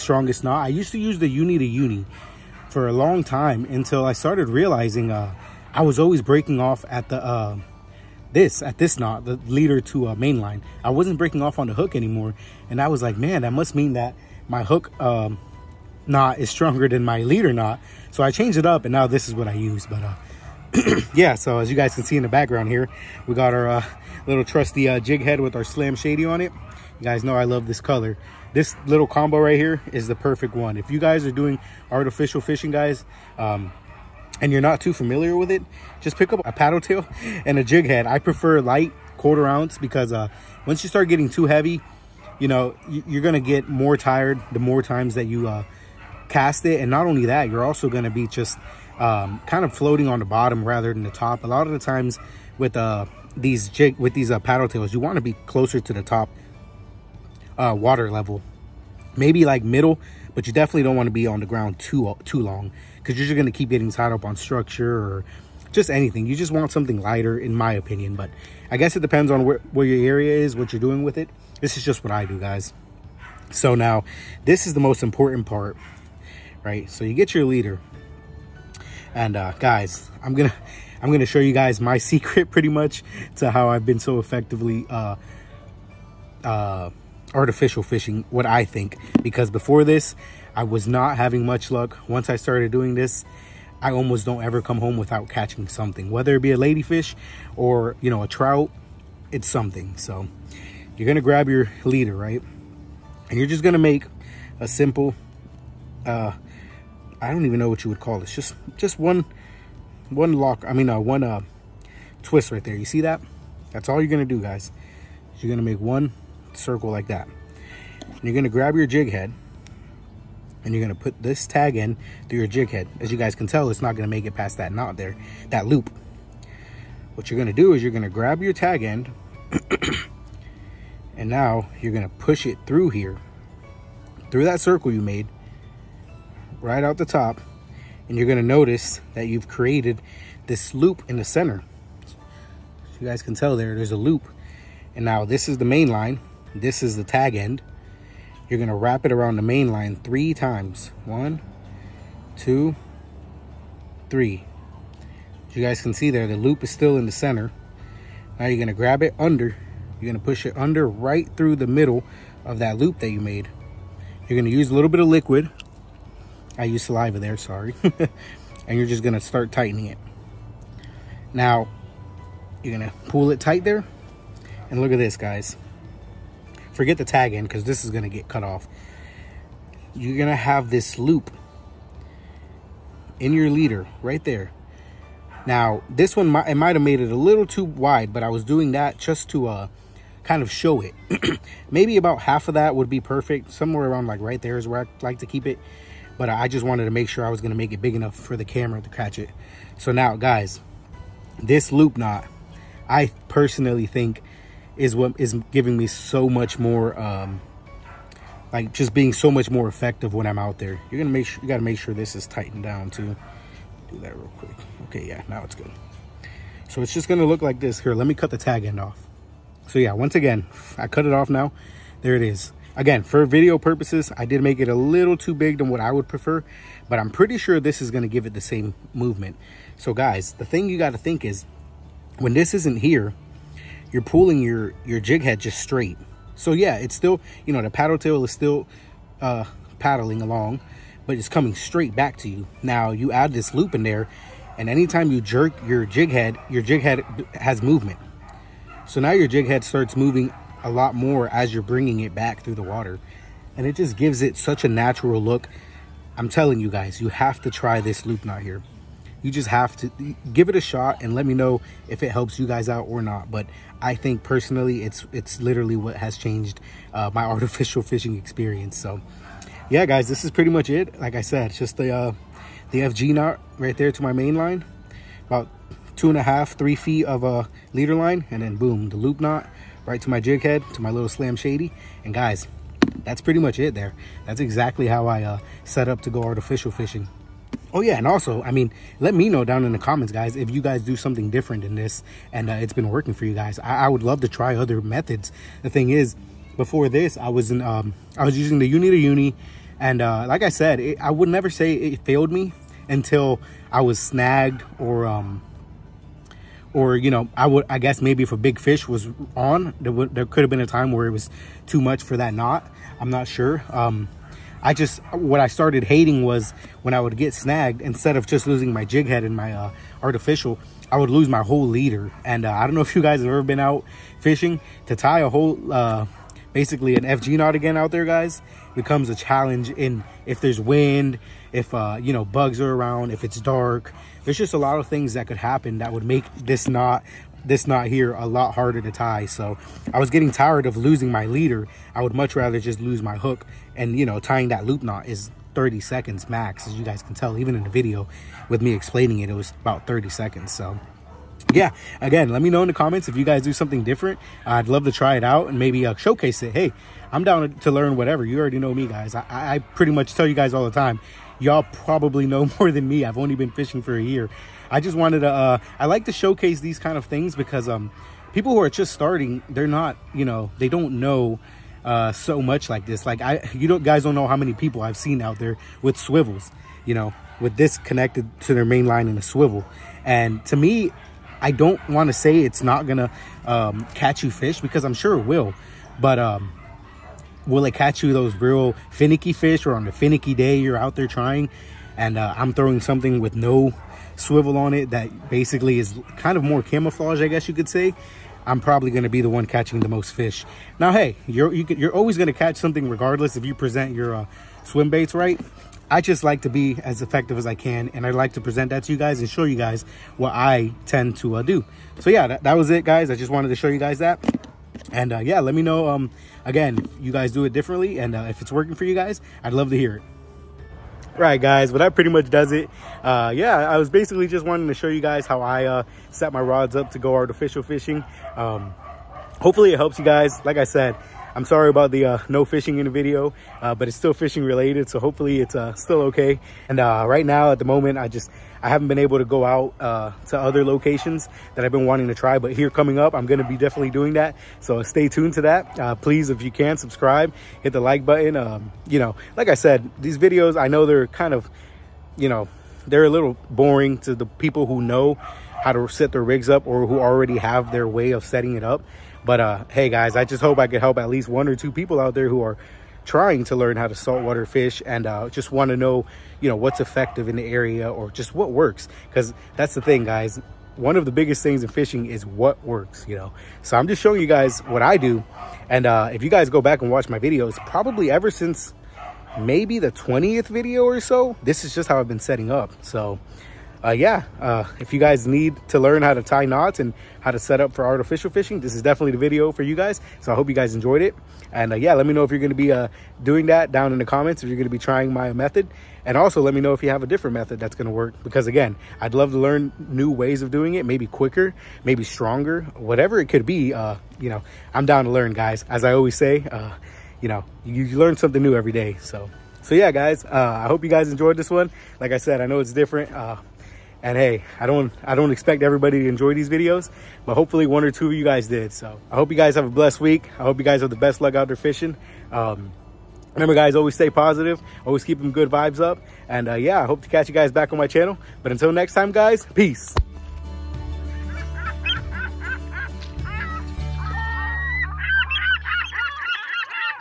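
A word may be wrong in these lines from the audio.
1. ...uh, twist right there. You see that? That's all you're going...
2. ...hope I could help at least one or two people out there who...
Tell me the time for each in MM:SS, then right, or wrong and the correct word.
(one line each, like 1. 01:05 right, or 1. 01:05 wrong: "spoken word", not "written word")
1. 01:51 right
2. 07:40 right.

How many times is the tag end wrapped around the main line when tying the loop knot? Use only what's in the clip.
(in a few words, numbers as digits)
3.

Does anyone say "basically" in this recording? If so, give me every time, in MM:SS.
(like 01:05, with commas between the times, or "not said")
05:26, 06:35, 07:03.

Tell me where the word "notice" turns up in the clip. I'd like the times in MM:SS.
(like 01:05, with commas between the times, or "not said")
02:18.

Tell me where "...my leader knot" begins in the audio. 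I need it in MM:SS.
00:17.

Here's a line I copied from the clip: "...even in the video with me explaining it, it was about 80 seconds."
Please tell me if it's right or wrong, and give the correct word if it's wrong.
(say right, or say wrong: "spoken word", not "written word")
wrong: "30", not "80".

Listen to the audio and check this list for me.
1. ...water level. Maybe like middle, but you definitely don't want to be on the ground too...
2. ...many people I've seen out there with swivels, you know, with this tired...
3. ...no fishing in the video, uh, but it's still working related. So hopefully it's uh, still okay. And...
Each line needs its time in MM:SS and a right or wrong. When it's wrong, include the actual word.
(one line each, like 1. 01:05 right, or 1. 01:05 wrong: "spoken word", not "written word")
1. 00:57 right
2. 06:14 wrong: "connected", not "tired"
3. 07:12 wrong: "fishing", not "working".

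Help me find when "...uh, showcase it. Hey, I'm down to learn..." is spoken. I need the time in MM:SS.
05:55.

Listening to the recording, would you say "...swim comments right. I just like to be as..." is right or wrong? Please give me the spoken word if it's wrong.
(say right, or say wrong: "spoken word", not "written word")
wrong: "baits", not "comments".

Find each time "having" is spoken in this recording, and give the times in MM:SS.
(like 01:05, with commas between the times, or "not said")
01:31.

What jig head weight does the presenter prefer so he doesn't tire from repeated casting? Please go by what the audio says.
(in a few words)
quarter ounce.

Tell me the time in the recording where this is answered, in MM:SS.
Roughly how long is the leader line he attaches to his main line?
04:35.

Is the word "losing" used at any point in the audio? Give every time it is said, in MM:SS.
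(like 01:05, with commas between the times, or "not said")
05:18, 05:40.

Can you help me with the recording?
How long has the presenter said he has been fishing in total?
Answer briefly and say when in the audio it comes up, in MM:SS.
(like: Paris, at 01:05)
1 year, at 06:03.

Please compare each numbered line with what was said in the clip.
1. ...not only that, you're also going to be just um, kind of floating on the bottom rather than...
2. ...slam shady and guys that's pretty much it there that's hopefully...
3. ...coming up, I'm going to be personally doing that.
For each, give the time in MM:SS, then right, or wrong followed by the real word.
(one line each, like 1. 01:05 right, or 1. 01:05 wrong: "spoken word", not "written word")
1. 00:46 right
2. 04:41 wrong: "exactly", not "hopefully"
3. 07:22 wrong: "definitely", not "personally".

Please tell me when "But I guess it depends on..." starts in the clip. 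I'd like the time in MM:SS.
01:08.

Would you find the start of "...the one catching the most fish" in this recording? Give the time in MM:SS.
06:39.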